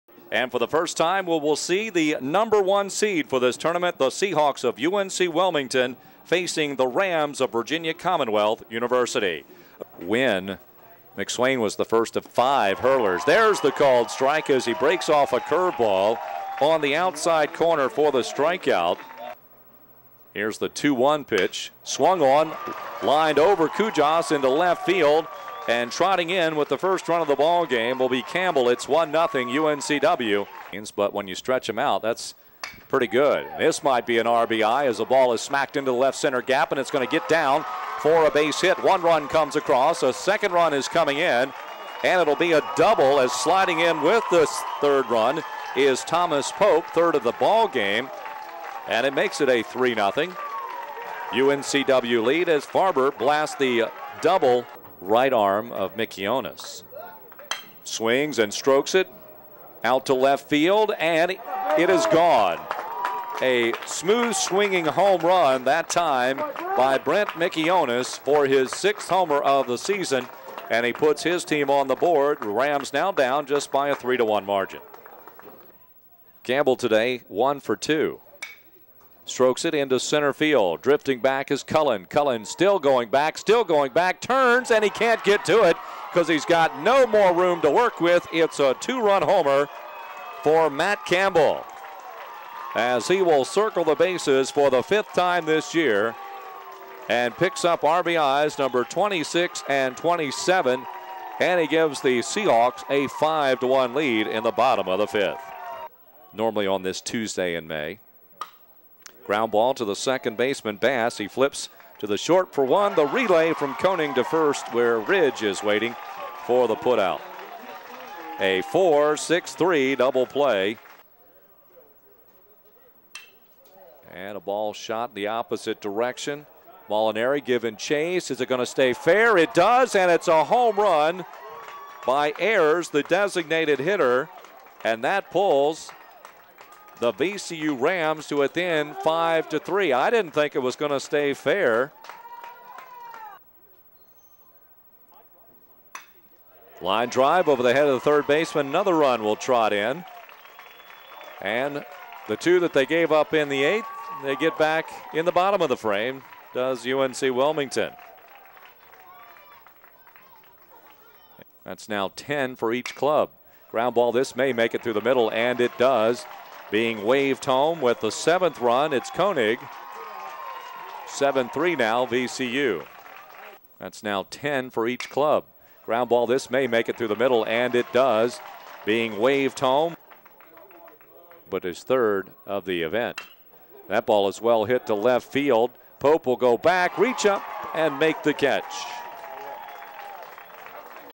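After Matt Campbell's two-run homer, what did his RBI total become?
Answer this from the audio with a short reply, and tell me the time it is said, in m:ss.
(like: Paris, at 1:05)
26 and 27, at 1:38.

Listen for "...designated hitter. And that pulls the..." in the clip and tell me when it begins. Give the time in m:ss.
2:13.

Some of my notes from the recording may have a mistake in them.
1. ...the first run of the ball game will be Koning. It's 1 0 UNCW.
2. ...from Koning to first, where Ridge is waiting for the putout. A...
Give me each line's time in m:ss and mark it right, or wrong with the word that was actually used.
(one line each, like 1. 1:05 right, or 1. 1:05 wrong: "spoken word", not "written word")
1. 0:26 wrong: "Campbell", not "Koning"
2. 1:53 right.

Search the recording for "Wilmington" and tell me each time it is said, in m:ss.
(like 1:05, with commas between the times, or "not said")
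0:05, 2:37.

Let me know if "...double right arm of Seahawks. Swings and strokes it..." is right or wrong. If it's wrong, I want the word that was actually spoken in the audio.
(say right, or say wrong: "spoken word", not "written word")
wrong: "Mikionis", not "Seahawks".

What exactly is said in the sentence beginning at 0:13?
There's the called strike as he breaks off a curveball on the outside corner for the strikeout.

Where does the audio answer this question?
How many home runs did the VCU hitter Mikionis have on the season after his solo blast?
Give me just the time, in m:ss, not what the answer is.
1:08.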